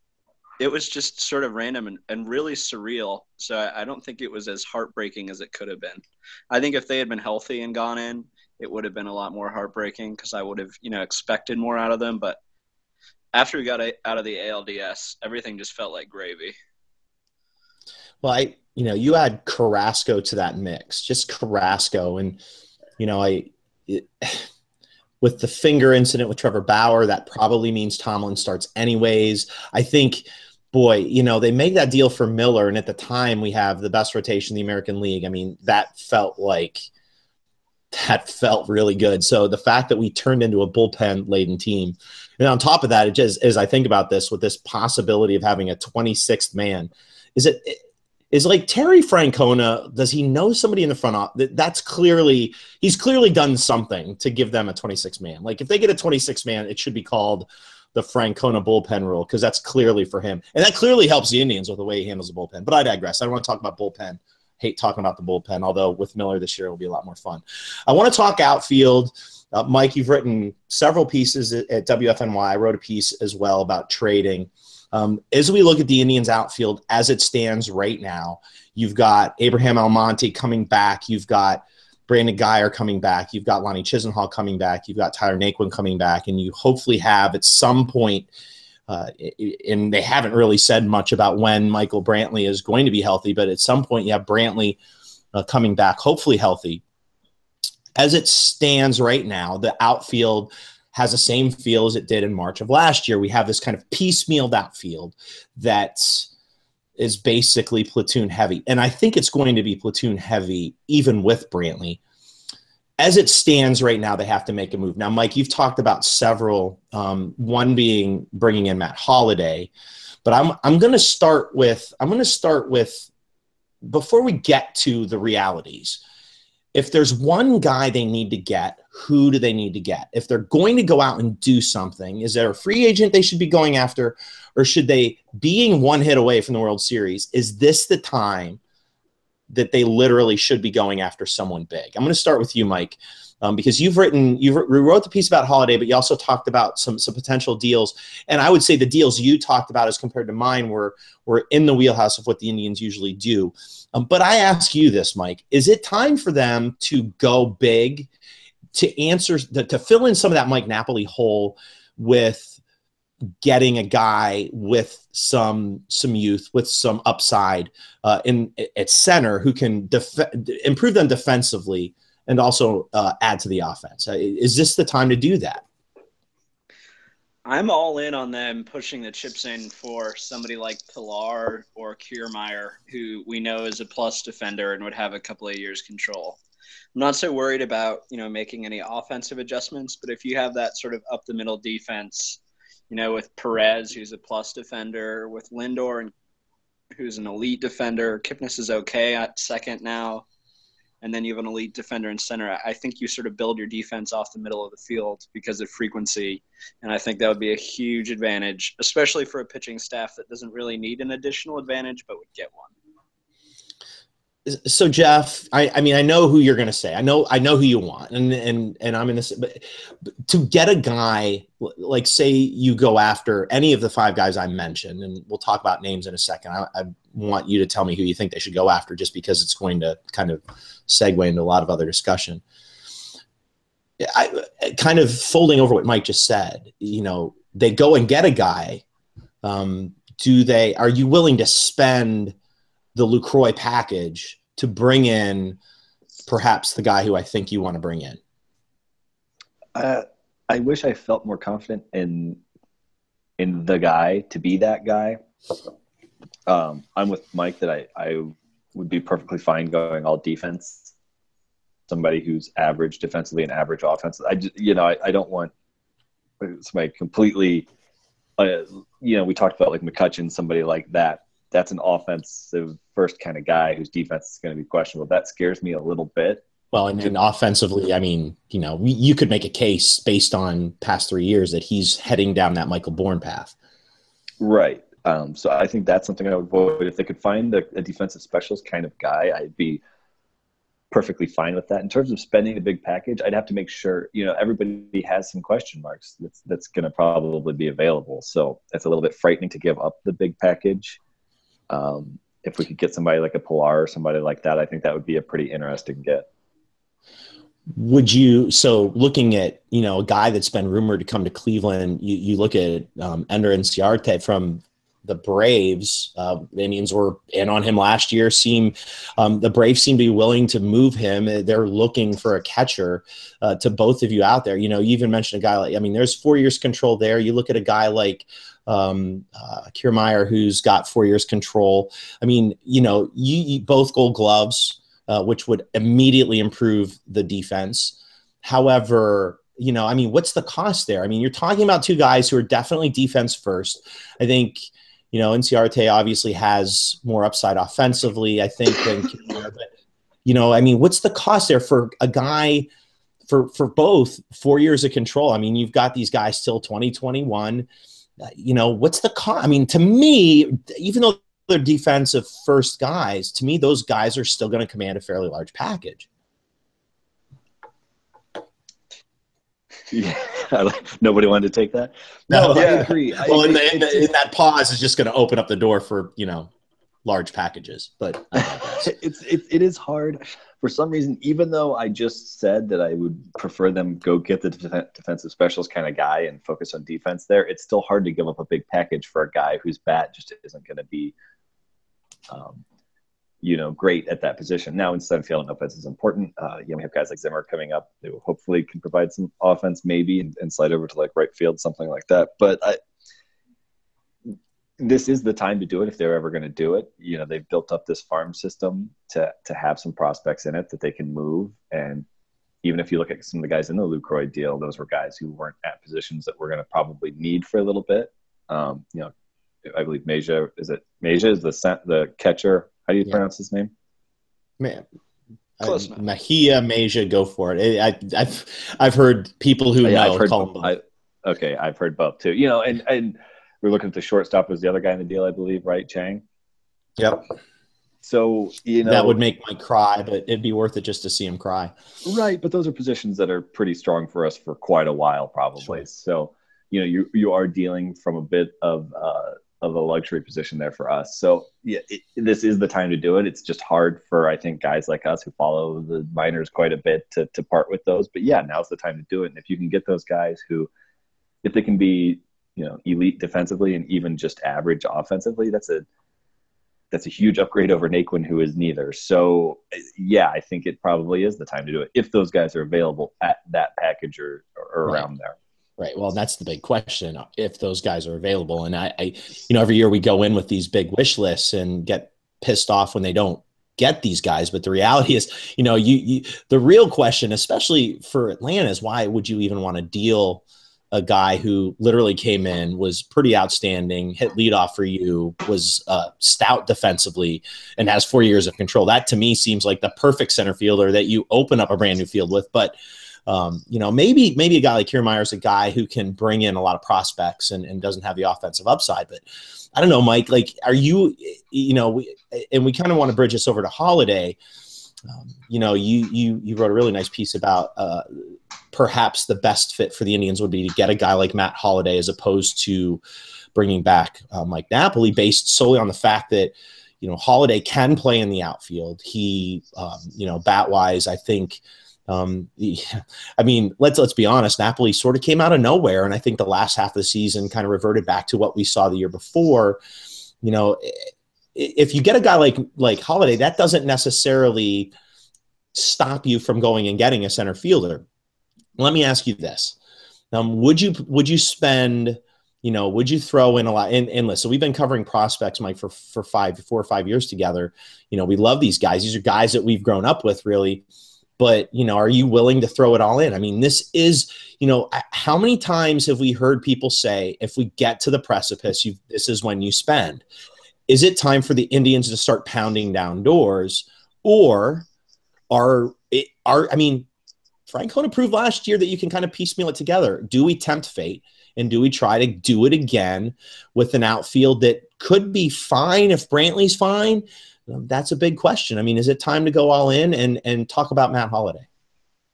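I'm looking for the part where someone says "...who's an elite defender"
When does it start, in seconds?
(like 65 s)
196 s.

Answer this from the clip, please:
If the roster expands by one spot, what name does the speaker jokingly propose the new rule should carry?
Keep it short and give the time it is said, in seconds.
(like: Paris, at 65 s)
Francona bullpen rule, at 58 s.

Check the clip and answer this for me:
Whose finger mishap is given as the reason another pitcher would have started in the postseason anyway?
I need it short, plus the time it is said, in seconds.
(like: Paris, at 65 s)
Trevor Bauer, at 26 s.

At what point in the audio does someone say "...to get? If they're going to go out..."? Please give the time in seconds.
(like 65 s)
129 s.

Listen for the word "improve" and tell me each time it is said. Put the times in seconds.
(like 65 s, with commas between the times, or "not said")
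170 s, 336 s.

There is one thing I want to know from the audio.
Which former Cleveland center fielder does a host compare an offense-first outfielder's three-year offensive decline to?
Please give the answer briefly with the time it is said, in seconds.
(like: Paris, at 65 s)
Michael Bourn, at 282 s.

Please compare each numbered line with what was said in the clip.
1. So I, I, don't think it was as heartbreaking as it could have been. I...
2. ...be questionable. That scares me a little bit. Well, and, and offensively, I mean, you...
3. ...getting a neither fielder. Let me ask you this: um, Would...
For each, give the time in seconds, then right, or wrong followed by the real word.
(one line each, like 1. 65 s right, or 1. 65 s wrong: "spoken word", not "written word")
1. 3 s right
2. 274 s right
3. 546 s wrong: "center", not "neither".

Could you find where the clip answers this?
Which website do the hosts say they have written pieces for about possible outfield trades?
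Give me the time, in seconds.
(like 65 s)
71 s.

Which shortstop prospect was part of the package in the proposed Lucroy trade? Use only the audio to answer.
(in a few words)
Chang.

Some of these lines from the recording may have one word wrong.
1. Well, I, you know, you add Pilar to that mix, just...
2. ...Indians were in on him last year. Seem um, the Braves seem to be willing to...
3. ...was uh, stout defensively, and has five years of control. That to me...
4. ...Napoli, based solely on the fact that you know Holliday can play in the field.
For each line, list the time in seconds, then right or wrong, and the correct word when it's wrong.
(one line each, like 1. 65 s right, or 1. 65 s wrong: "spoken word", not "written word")
1. 18 s wrong: "Carrasco", not "Pilar"
2. 316 s right
3. 495 s wrong: "four", not "five"
4. 524 s wrong: "outfield", not "field".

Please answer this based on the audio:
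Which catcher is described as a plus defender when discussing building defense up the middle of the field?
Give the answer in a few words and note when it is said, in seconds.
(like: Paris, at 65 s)
Perez, at 193 s.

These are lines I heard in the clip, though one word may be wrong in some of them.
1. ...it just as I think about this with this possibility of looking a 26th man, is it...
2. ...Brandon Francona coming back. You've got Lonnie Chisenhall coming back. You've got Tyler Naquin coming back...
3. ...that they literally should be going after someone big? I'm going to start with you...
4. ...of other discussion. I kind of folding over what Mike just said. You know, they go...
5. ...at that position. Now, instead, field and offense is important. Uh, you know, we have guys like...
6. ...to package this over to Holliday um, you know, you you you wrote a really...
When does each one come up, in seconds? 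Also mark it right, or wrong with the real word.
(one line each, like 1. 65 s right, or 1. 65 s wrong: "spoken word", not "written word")
1. 43 s wrong: "having", not "looking"
2. 82 s wrong: "Guyer", not "Francona"
3. 139 s right
4. 231 s right
5. 394 s right
6. 513 s wrong: "bridge", not "package".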